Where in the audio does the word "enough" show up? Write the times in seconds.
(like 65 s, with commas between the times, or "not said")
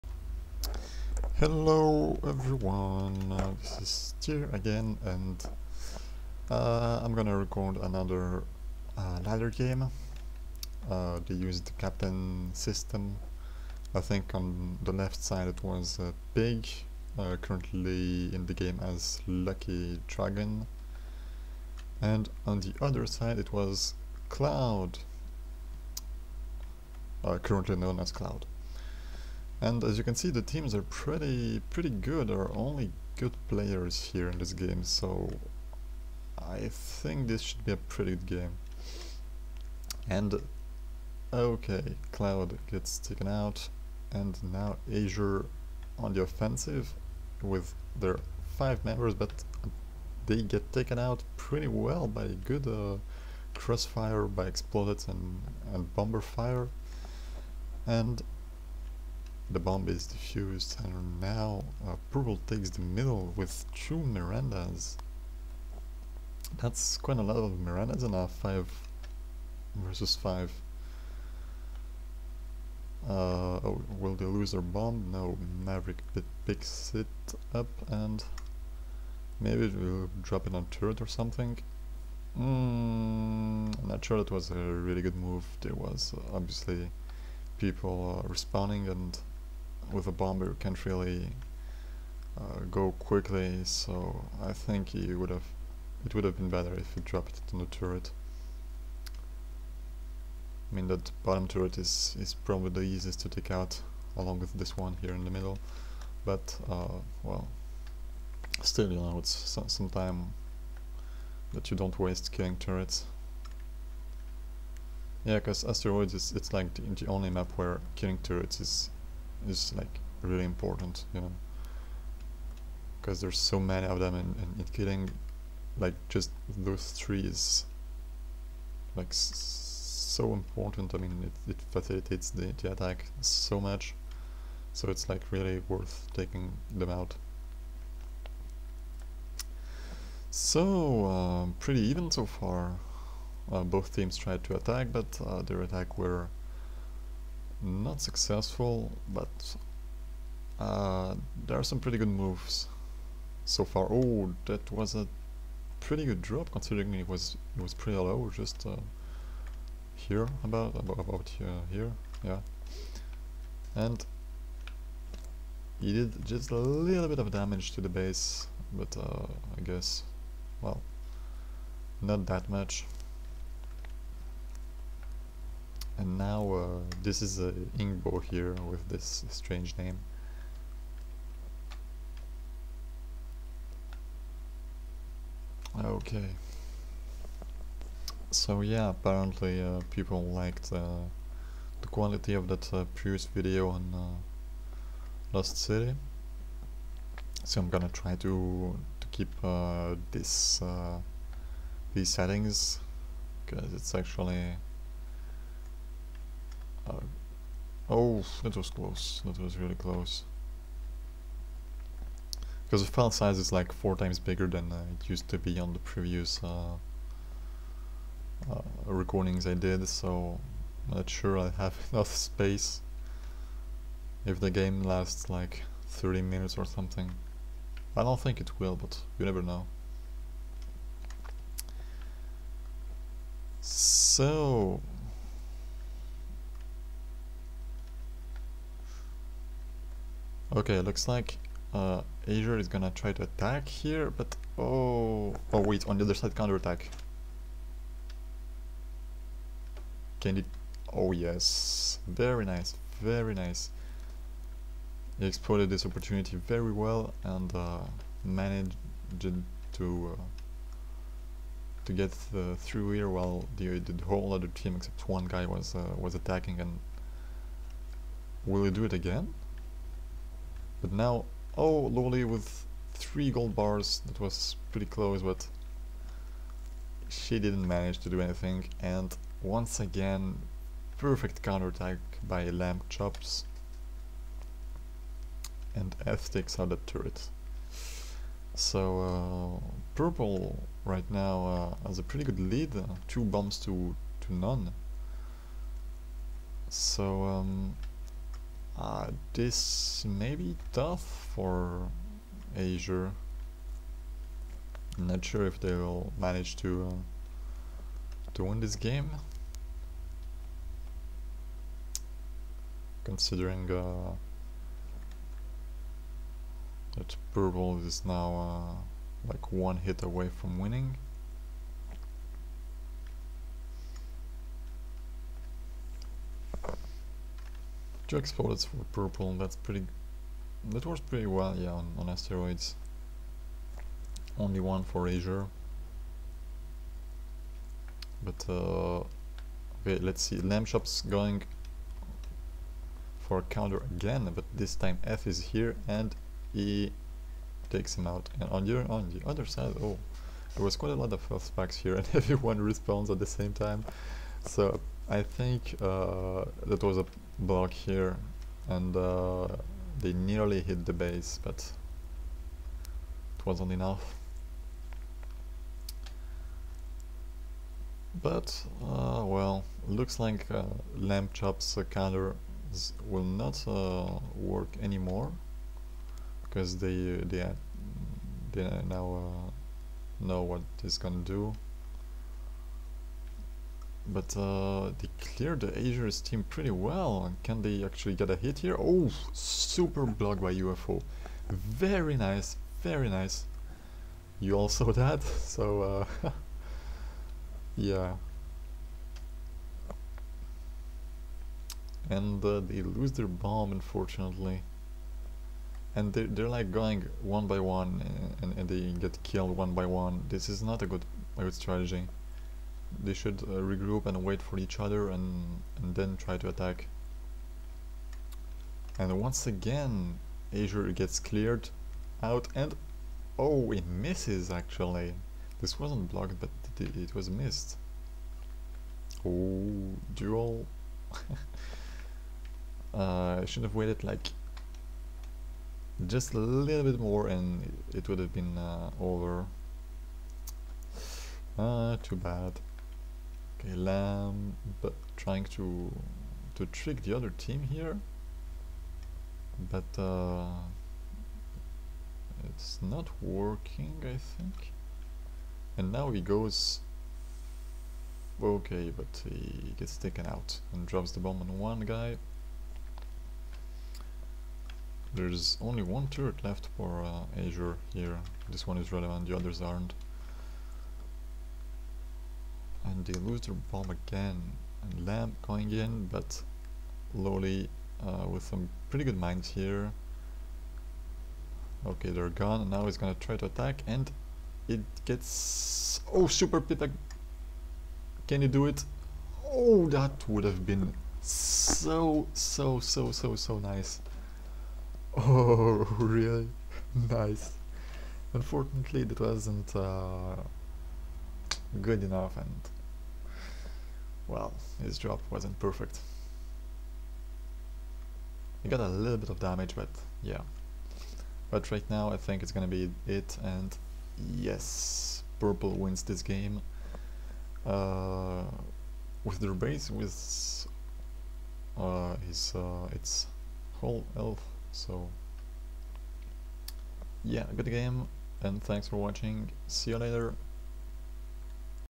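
221 s, 363 s, 502 s.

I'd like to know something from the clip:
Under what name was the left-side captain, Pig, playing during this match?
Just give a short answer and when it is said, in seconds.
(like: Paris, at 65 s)
Lucky Dragon, at 19 s.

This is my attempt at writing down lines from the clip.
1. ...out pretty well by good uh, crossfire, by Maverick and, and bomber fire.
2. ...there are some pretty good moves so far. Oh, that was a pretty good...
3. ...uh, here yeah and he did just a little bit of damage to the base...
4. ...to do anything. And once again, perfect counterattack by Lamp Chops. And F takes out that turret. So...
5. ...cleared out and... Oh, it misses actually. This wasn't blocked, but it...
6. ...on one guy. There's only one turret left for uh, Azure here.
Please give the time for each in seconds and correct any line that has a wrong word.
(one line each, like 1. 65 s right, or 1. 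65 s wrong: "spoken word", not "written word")
1. 50 s wrong: "Explodet", not "Maverick"
2. 151 s right
3. 161 s right
4. 277 s right
5. 421 s right
6. 461 s right.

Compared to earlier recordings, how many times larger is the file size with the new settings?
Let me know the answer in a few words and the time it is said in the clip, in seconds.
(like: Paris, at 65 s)
4, at 213 s.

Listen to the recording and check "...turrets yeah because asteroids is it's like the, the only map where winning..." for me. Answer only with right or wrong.
wrong.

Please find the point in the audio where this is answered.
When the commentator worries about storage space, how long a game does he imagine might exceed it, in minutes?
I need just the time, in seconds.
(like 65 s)
225 s.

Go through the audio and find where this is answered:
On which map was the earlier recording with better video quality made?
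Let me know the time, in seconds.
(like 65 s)
195 s.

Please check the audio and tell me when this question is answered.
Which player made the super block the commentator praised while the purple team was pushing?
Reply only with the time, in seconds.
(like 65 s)
390 s.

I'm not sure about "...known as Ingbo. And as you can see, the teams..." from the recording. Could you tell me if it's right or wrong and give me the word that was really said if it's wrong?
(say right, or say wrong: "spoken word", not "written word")
wrong: "Cloud", not "Ingbo".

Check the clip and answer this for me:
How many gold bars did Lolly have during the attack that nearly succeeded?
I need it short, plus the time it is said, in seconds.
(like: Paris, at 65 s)
3, at 272 s.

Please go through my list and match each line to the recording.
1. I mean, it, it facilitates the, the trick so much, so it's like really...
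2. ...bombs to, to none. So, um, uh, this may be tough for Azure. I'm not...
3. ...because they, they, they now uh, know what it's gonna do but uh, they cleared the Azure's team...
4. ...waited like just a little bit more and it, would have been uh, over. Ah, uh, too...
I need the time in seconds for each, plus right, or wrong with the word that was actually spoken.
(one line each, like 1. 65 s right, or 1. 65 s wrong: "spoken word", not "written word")
1. 130 s wrong: "attack", not "trick"
2. 293 s right
3. 376 s right
4. 433 s right.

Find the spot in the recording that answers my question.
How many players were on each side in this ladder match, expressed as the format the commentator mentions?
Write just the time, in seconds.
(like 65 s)
68 s.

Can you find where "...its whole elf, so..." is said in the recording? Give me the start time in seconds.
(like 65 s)
522 s.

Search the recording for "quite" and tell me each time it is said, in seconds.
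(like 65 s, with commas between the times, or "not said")
66 s, 350 s.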